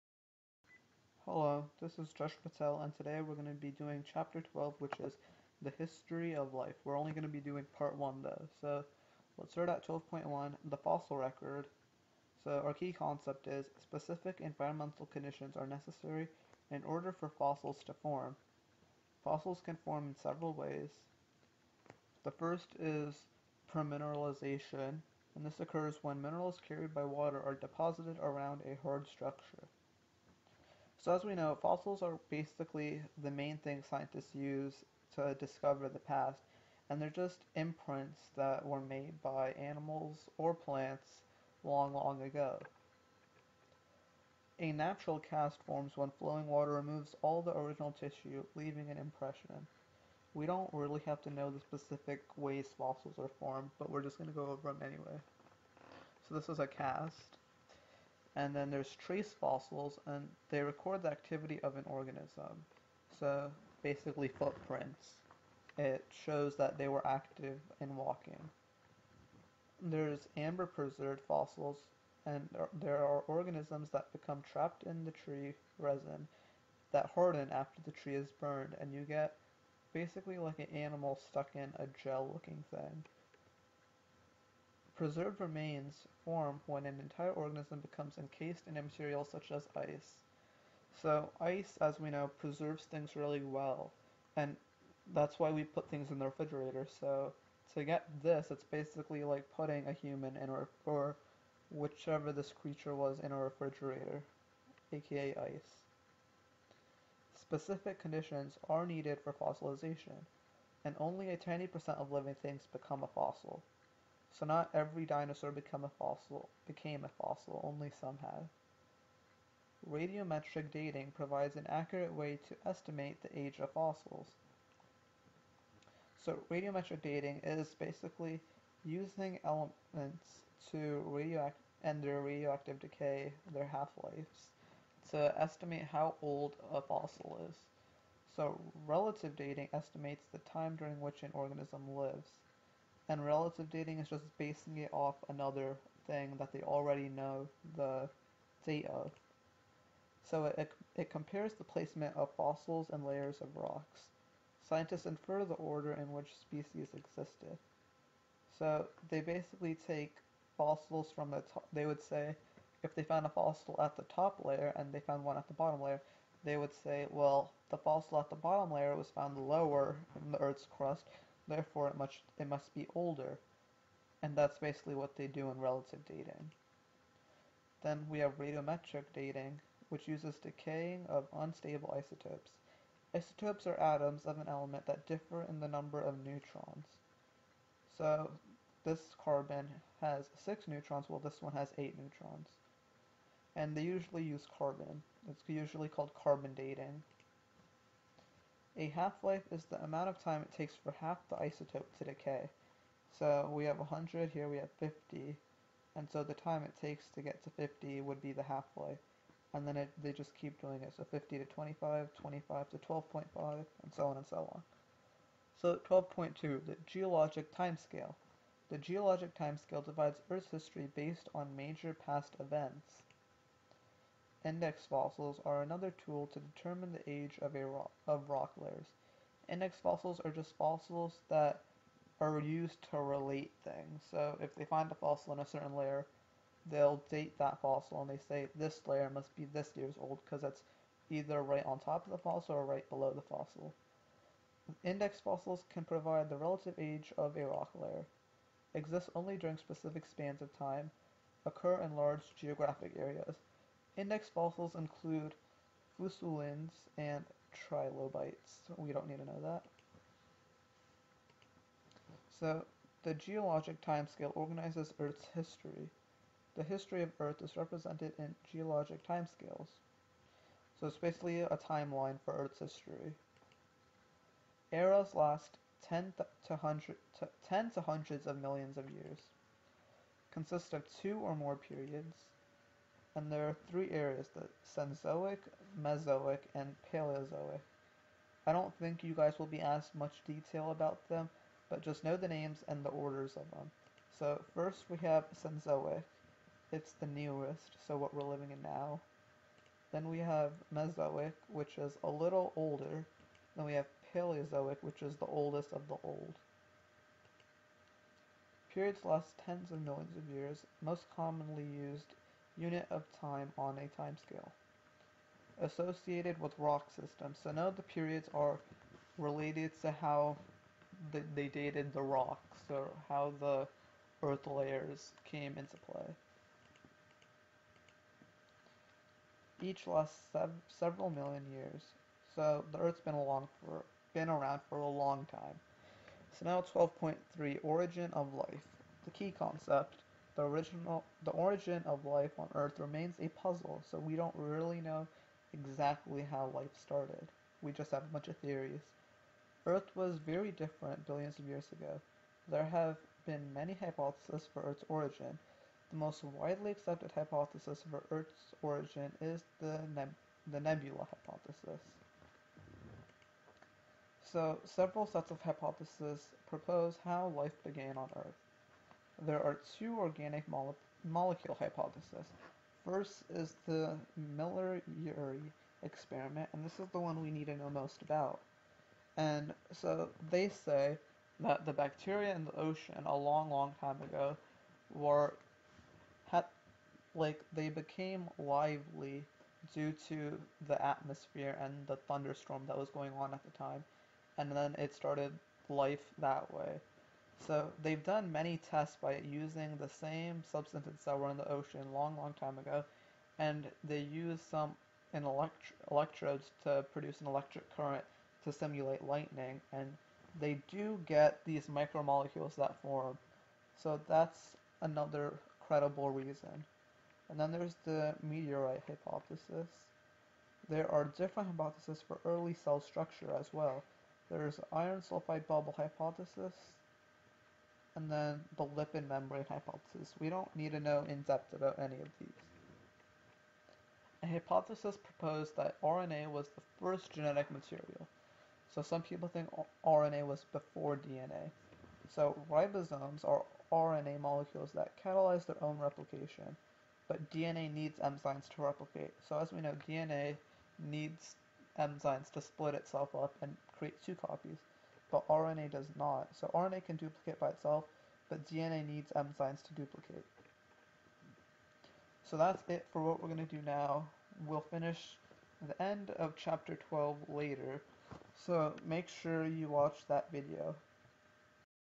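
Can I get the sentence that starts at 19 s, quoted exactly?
Fossils can form in several ways.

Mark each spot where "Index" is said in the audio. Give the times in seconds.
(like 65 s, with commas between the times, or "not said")
224 s, 229 s, 244 s, 253 s.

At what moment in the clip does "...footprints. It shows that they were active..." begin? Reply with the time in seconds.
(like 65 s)
64 s.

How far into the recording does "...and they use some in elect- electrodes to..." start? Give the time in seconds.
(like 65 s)
403 s.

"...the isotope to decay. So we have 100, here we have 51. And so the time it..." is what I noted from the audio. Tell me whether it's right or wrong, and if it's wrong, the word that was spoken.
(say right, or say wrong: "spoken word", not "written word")
wrong: "50", not "51".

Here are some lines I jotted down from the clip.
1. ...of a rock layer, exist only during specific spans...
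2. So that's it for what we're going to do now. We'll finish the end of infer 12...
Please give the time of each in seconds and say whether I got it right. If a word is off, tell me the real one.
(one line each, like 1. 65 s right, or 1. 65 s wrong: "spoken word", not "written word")
1. 247 s right
2. 462 s wrong: "chapter", not "infer".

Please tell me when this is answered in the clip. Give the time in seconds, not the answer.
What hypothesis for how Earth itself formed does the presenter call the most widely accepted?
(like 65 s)
360 s.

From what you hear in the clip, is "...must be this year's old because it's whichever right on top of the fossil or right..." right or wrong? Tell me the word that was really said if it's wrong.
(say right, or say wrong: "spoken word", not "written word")
wrong: "either", not "whichever".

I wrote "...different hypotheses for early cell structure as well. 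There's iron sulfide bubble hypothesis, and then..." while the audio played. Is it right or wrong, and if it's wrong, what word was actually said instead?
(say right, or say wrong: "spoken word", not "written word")
right.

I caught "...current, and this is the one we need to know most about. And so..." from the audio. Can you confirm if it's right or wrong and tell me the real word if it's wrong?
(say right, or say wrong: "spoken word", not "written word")
wrong: "experiment", not "current".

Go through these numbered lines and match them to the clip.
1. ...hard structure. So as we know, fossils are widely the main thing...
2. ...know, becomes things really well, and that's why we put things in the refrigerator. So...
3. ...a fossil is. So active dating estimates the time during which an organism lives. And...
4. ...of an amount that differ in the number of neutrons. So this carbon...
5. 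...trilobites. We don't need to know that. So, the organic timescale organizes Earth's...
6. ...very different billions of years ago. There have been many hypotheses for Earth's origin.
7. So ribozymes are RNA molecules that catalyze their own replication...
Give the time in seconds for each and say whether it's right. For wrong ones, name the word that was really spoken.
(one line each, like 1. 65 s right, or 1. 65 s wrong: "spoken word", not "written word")
1. 28 s wrong: "basically", not "widely"
2. 92 s wrong: "preserves", not "becomes"
3. 136 s wrong: "relative", not "active"
4. 184 s wrong: "element", not "amount"
5. 257 s wrong: "geologic", not "organic"
6. 350 s right
7. 442 s right.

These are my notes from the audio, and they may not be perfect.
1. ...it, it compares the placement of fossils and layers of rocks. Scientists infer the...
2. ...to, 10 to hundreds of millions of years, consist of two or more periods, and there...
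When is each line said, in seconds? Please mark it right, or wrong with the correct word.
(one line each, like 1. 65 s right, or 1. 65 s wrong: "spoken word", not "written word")
1. 150 s right
2. 277 s right.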